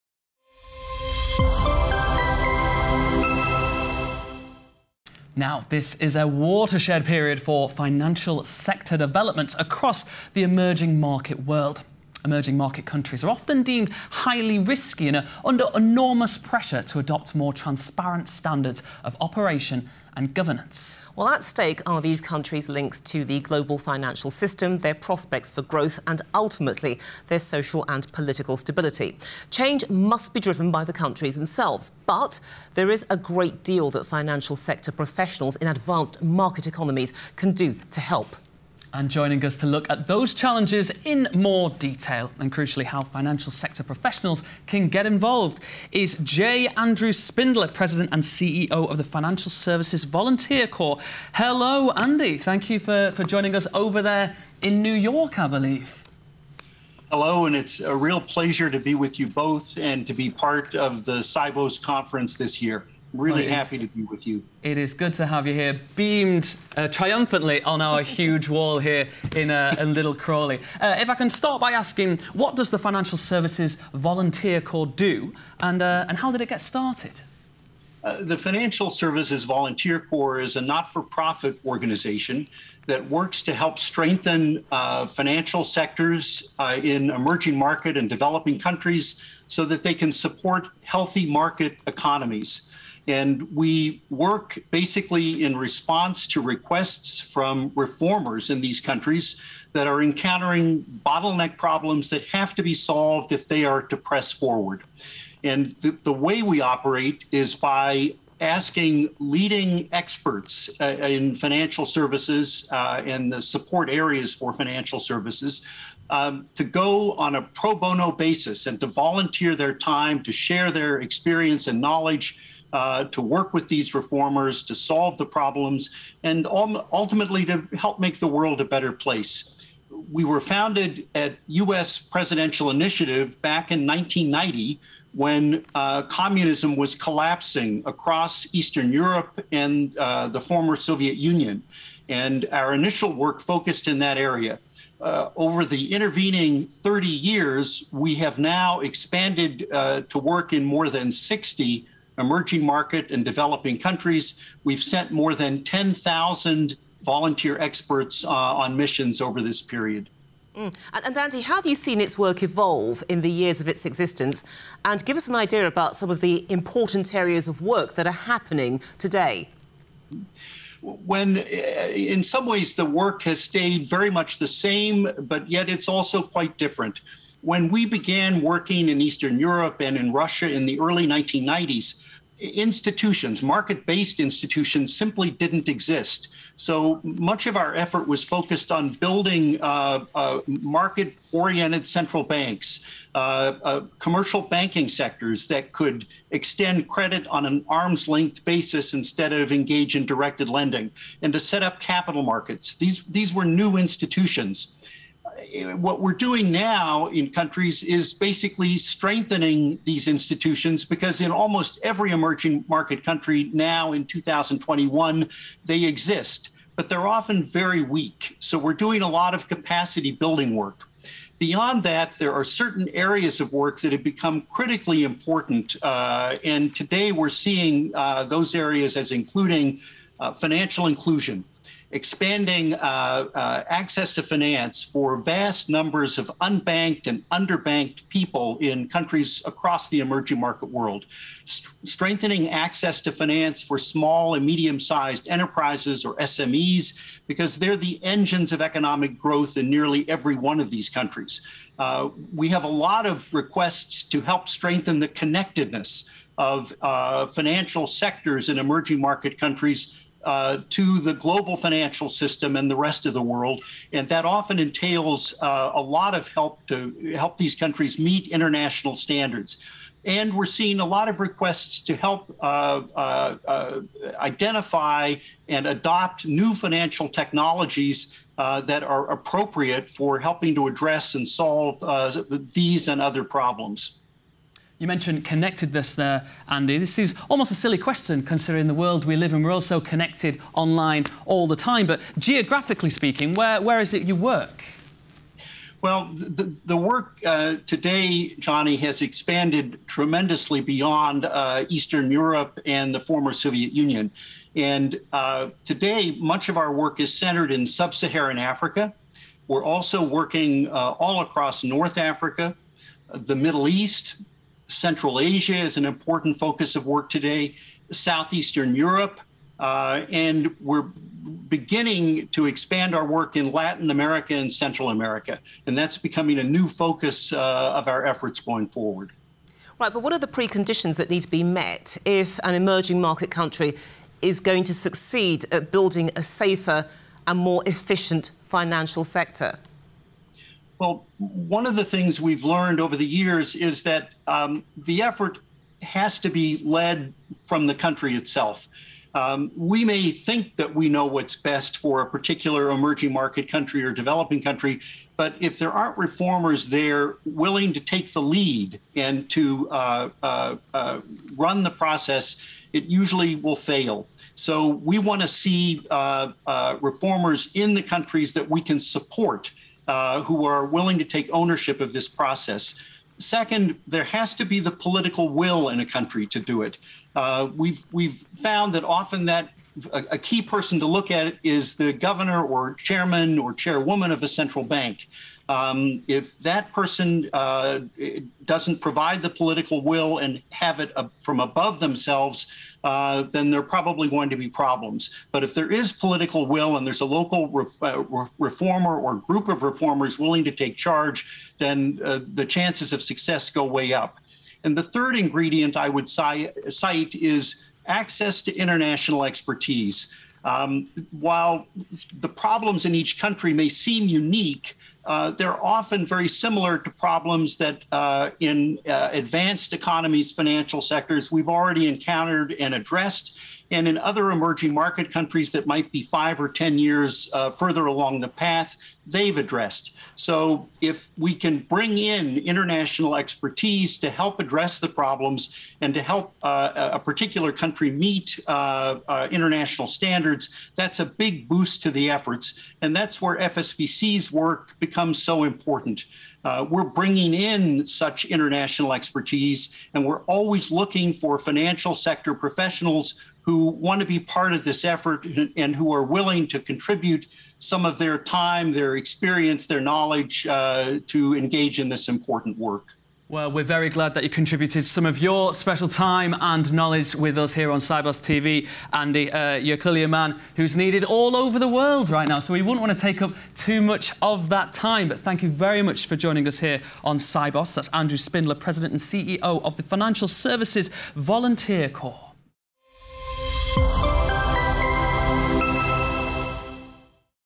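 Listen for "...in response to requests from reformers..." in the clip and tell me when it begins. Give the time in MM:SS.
01:35.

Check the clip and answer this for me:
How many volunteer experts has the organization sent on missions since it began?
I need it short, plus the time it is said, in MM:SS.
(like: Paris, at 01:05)
more than 10,000, at 02:35.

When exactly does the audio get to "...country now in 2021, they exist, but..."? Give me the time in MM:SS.
03:33.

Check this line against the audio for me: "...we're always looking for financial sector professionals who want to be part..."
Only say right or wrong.
right.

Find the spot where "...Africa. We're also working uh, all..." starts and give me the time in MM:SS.
05:08.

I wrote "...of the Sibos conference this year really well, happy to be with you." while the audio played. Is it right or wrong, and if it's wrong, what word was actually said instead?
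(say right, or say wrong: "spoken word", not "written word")
right.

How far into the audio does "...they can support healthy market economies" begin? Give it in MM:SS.
01:29.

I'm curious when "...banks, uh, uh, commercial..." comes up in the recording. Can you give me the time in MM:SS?
03:12.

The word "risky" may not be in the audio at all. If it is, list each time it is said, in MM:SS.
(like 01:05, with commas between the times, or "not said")
00:14.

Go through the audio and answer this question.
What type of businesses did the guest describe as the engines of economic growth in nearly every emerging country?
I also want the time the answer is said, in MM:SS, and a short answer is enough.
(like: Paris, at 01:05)
SMEs, at 04:06.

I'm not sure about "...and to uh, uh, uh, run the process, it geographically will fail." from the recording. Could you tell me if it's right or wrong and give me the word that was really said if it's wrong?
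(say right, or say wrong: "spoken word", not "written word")
wrong: "usually", not "geographically".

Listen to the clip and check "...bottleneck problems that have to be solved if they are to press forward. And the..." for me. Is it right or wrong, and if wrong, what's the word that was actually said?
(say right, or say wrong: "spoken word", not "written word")
right.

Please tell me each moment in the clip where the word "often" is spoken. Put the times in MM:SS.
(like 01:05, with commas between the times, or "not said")
00:13, 03:37, 04:24, 06:18, 06:55.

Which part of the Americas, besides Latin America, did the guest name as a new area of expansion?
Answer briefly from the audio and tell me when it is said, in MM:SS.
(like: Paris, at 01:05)
Central America, at 05:24.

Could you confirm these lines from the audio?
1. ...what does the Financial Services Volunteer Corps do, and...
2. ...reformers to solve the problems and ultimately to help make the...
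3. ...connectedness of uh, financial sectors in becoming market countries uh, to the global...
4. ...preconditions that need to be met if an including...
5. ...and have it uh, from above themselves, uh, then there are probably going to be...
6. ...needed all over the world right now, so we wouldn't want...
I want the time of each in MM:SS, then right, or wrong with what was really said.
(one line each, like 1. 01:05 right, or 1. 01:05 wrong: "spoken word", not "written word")
1. 01:12 right
2. 02:03 right
3. 04:15 wrong: "emerging", not "becoming"
4. 05:30 wrong: "emerging", not "including"
5. 06:30 right
6. 07:50 right.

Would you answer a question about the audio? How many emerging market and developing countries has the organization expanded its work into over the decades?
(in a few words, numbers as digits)
more than 60.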